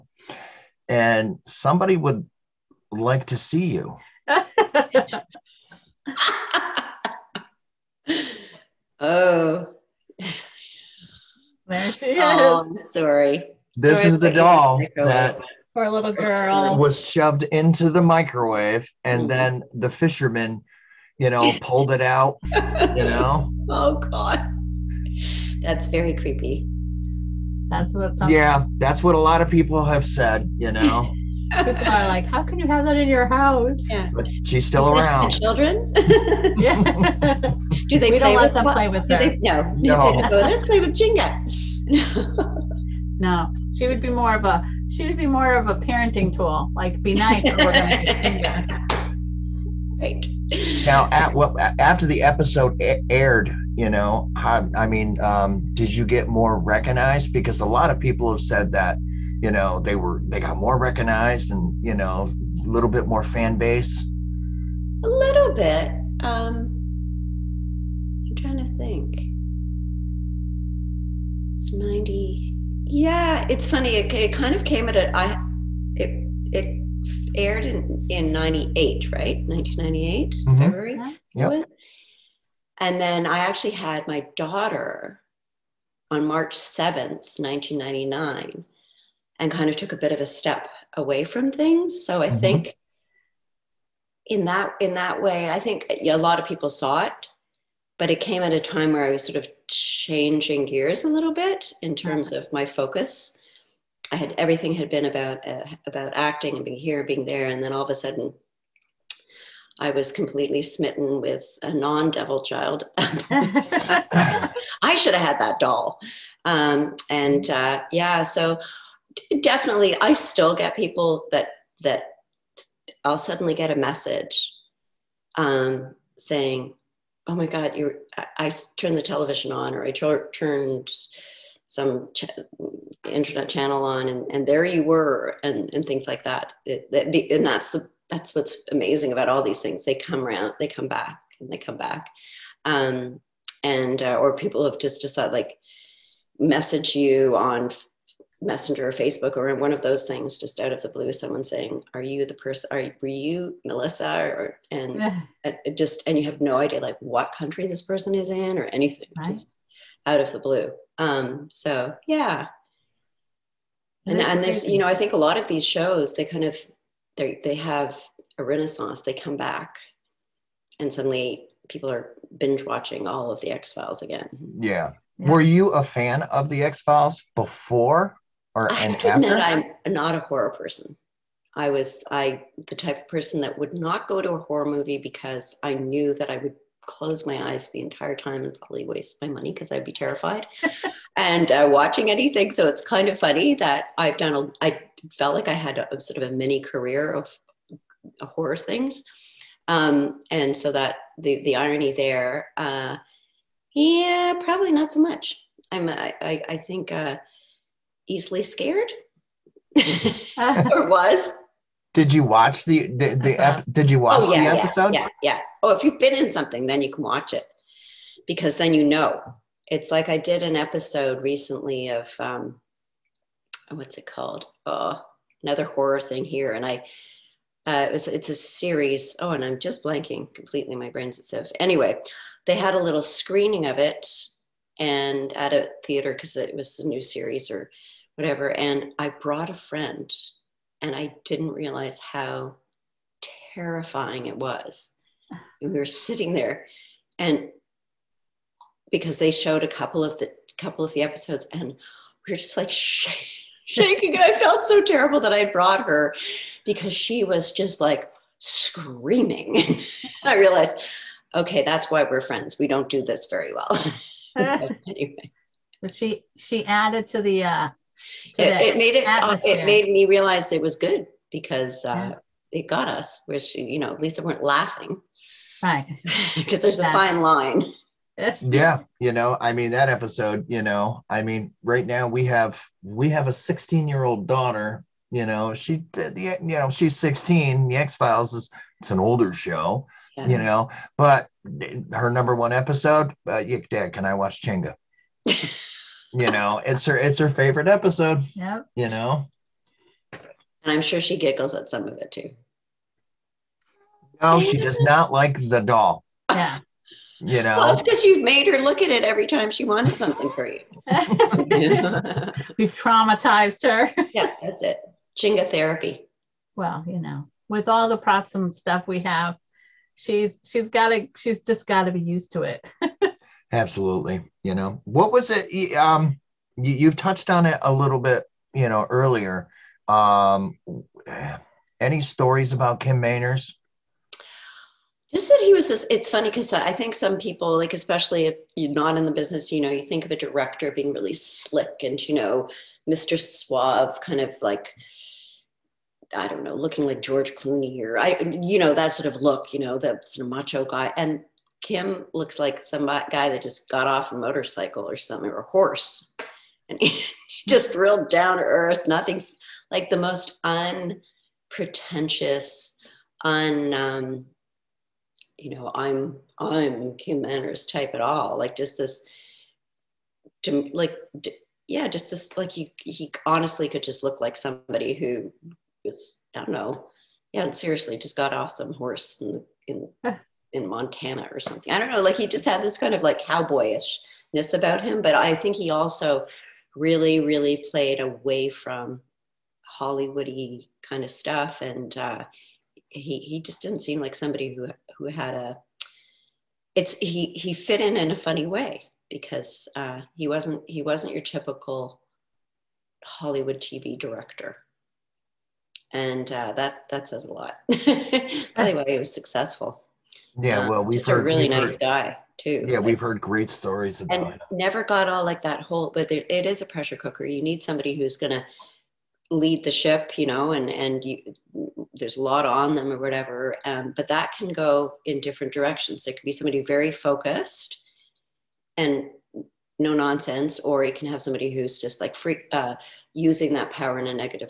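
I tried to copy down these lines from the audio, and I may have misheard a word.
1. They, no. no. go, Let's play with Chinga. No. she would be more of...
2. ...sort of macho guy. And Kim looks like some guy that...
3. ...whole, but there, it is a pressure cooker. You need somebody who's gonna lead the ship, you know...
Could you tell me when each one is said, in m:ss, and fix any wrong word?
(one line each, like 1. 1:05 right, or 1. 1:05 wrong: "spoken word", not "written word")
1. 0:39 right
2. 5:50 right
3. 6:55 right.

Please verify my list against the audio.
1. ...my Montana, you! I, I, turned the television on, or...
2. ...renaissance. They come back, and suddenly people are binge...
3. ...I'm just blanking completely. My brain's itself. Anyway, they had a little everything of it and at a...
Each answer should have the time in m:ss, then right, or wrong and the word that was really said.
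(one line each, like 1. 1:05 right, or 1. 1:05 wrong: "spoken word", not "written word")
1. 2:07 wrong: "God", not "Montana"
2. 2:48 right
3. 3:49 wrong: "screening", not "everything".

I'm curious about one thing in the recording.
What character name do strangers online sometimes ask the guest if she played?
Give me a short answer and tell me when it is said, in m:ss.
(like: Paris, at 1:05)
Melissa, at 2:33.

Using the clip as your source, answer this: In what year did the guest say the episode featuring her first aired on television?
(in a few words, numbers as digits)
1998.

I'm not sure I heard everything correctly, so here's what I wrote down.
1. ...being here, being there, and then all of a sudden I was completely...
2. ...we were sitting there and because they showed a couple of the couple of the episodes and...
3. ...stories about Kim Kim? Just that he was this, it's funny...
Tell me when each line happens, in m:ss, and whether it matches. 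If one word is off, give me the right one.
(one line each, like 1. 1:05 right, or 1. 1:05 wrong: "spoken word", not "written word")
1. 1:46 right
2. 4:05 right
3. 5:32 wrong: "Manners", not "Kim".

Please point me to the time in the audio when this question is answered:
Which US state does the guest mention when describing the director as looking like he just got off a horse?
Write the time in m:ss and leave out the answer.
6:20.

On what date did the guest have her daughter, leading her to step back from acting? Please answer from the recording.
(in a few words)
March 7, 1999.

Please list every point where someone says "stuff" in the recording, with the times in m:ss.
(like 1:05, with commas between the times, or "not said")
5:18, 6:31.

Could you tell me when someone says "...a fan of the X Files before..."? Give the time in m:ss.
2:55.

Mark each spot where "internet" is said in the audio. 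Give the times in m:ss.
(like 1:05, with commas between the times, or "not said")
2:13.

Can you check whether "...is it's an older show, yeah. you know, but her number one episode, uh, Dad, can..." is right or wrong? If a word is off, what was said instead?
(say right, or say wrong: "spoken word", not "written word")
right.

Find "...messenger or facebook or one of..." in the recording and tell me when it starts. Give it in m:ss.
2:28.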